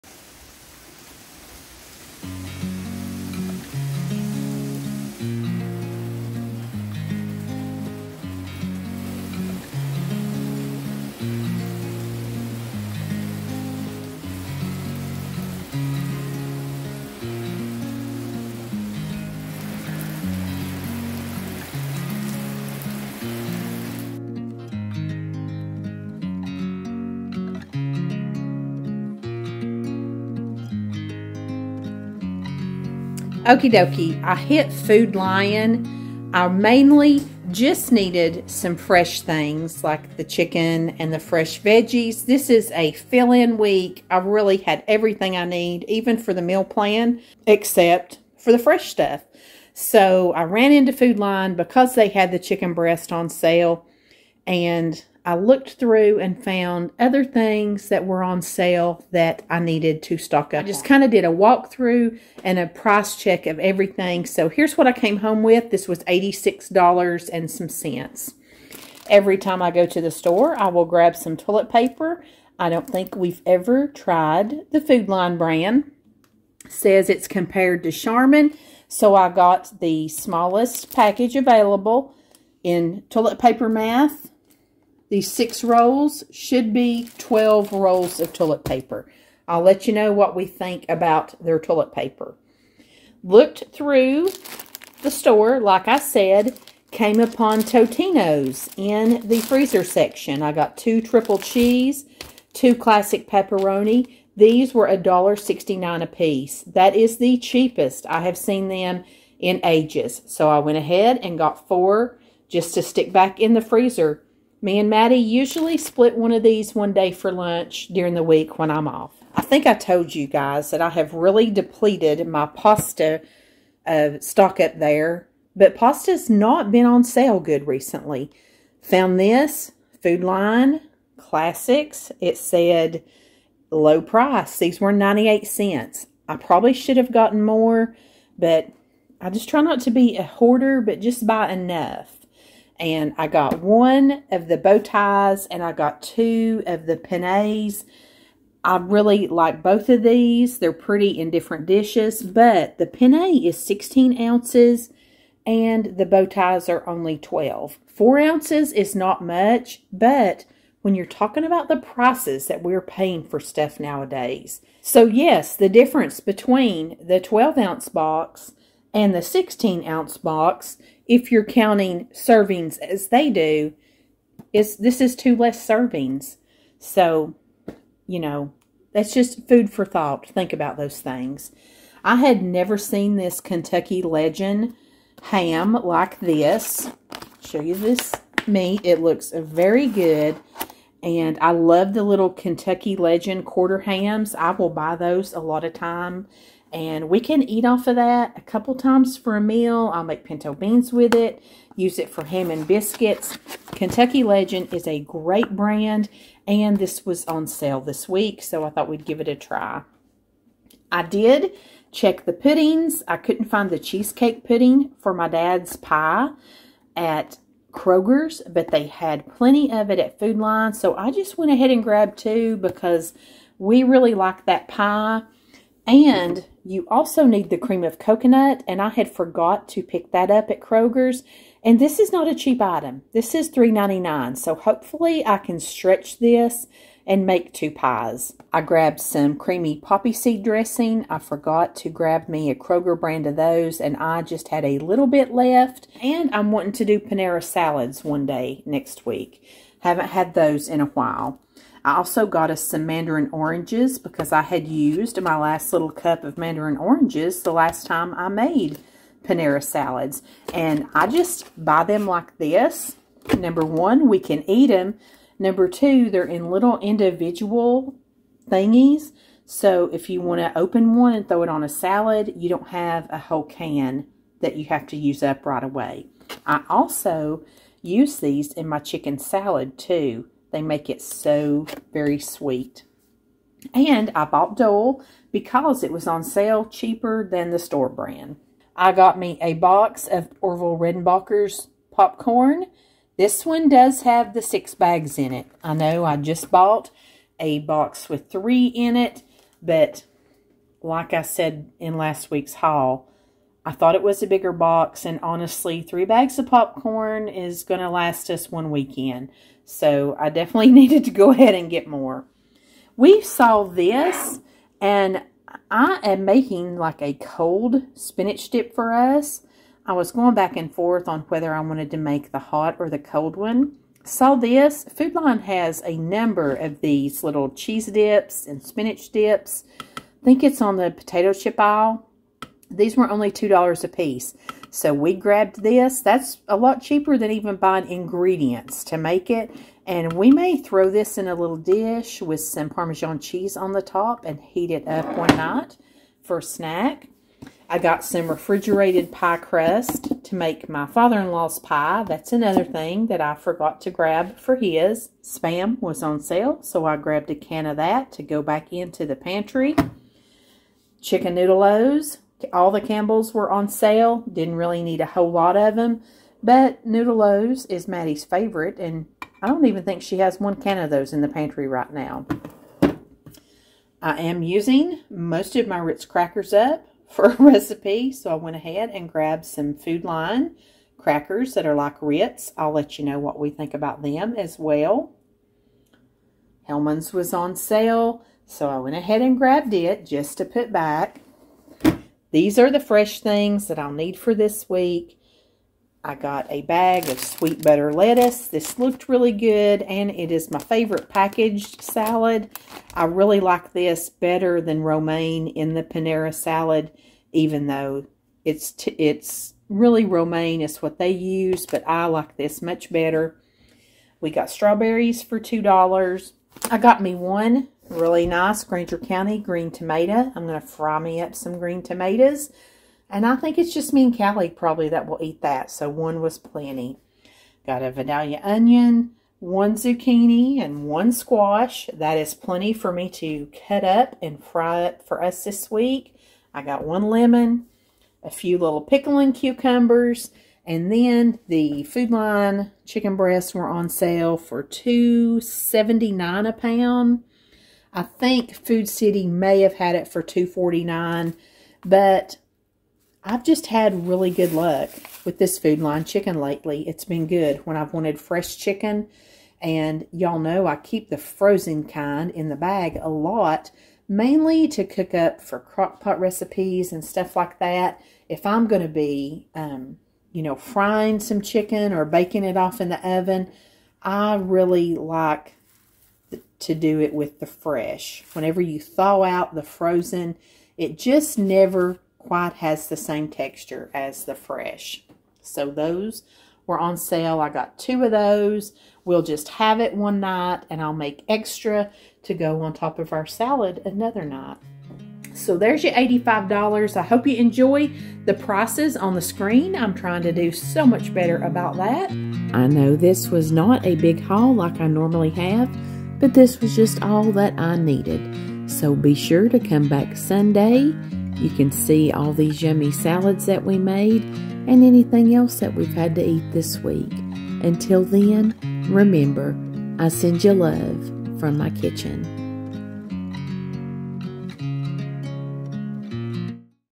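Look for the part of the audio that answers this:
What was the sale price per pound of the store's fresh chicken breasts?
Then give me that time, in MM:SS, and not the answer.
07:24.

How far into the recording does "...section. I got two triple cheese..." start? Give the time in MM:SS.
01:39.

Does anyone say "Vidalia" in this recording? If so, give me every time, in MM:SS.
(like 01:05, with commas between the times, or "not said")
07:07.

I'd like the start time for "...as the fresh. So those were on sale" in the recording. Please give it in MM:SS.
08:03.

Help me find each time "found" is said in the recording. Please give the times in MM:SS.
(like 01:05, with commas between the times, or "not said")
00:56, 02:08.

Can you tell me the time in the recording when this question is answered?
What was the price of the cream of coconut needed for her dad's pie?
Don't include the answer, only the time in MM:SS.
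03:53.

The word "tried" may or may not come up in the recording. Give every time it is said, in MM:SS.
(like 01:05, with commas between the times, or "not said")
01:13.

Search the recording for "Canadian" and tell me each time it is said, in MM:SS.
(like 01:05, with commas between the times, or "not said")
not said.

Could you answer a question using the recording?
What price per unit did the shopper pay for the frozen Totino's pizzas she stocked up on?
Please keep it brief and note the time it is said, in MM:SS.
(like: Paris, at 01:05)
$1.69, at 01:44.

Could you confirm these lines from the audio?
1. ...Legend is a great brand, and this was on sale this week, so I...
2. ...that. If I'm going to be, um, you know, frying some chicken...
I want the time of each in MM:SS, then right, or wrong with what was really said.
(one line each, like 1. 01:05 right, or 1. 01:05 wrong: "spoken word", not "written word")
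1. 03:24 right
2. 07:47 right.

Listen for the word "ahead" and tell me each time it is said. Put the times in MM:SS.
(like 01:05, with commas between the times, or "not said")
01:50, 03:41, 05:11, 06:18, 06:28.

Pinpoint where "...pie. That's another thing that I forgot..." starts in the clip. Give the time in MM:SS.
05:51.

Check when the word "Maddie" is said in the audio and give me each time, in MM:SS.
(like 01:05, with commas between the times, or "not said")
01:54, 06:07.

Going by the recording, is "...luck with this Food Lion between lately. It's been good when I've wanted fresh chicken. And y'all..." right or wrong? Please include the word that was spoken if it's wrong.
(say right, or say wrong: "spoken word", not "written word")
wrong: "chicken", not "between".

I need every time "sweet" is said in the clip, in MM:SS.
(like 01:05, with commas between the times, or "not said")
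04:42, 06:37.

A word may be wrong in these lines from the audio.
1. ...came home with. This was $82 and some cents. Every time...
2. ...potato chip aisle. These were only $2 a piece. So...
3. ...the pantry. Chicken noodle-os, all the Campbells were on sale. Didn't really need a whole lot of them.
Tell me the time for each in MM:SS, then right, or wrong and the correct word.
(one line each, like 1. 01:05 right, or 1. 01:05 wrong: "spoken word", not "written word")
1. 01:04 wrong: "86", not "82"
2. 05:30 right
3. 05:59 right.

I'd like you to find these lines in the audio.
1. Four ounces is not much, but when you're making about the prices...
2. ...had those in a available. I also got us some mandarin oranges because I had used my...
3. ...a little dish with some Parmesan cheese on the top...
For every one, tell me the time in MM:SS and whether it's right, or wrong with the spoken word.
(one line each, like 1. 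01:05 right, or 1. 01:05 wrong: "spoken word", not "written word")
1. 02:37 wrong: "talking", not "making"
2. 04:10 wrong: "while", not "available"
3. 05:41 right.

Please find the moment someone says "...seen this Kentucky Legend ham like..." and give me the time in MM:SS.
03:02.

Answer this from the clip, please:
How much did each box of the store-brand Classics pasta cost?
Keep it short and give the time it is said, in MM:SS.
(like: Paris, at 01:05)
98 cents, at 02:14.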